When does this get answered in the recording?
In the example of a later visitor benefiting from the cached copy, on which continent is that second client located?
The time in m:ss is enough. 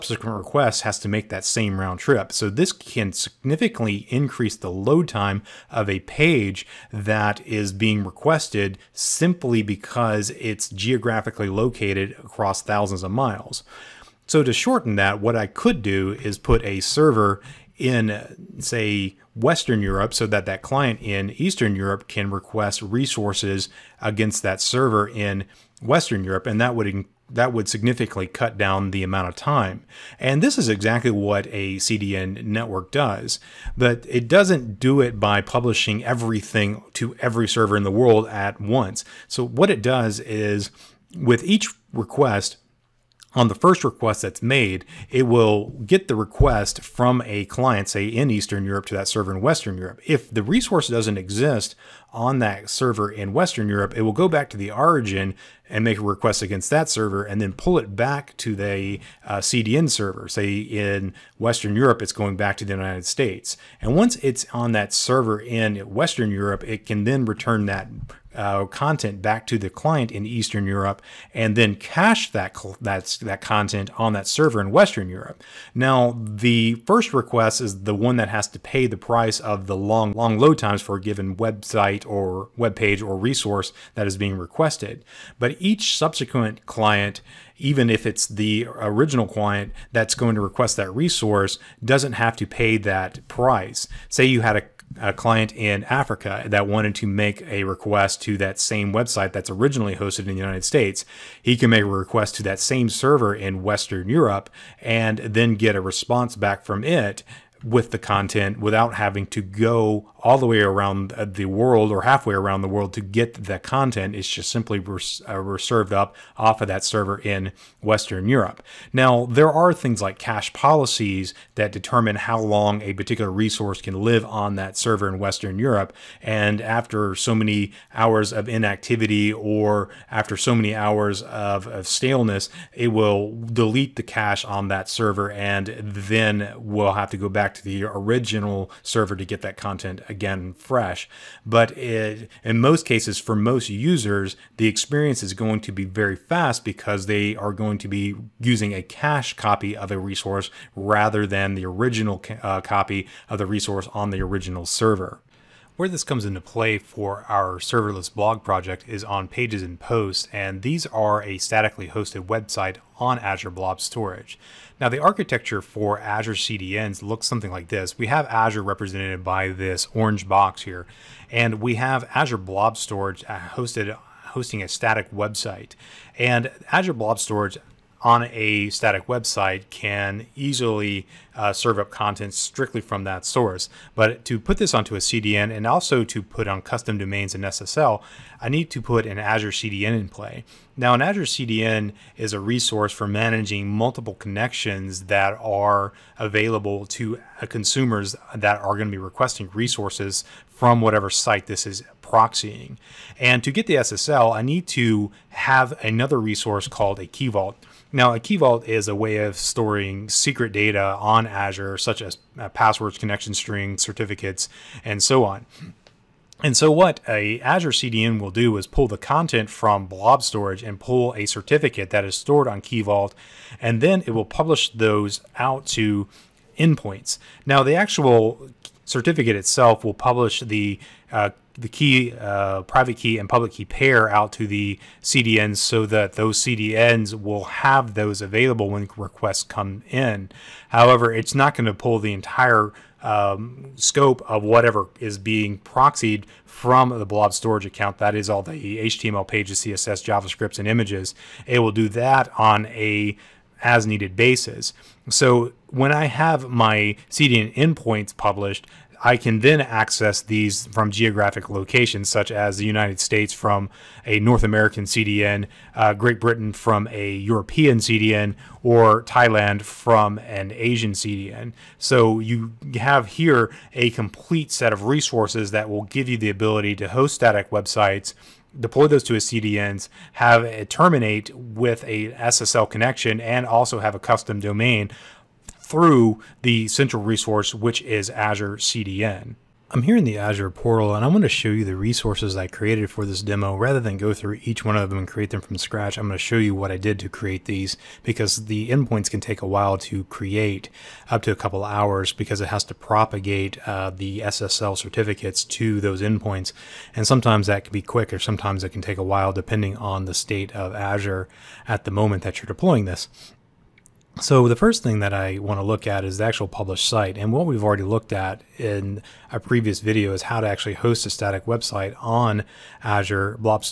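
1:35.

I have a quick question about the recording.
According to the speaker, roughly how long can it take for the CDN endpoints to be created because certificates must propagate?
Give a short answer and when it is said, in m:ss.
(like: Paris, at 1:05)
a couple hours, at 5:01.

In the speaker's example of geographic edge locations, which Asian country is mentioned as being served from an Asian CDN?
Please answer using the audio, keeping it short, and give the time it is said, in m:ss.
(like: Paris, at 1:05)
Thailand, at 4:29.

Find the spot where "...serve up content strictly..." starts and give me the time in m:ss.
3:01.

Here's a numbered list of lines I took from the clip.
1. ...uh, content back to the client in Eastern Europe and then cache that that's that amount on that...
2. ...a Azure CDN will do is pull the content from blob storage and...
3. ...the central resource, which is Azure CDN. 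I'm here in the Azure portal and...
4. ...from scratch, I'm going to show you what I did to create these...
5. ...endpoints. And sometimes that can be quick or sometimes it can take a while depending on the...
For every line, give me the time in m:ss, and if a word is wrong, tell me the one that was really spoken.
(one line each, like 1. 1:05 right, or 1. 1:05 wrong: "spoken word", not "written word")
1. 1:08 wrong: "content", not "amount"
2. 3:37 right
3. 4:46 right
4. 4:55 right
5. 5:06 right.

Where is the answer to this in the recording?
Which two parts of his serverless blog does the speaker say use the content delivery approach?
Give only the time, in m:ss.
2:39.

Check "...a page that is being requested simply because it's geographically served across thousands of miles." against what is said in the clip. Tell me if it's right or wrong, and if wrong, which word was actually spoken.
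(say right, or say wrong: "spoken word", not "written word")
wrong: "located", not "served".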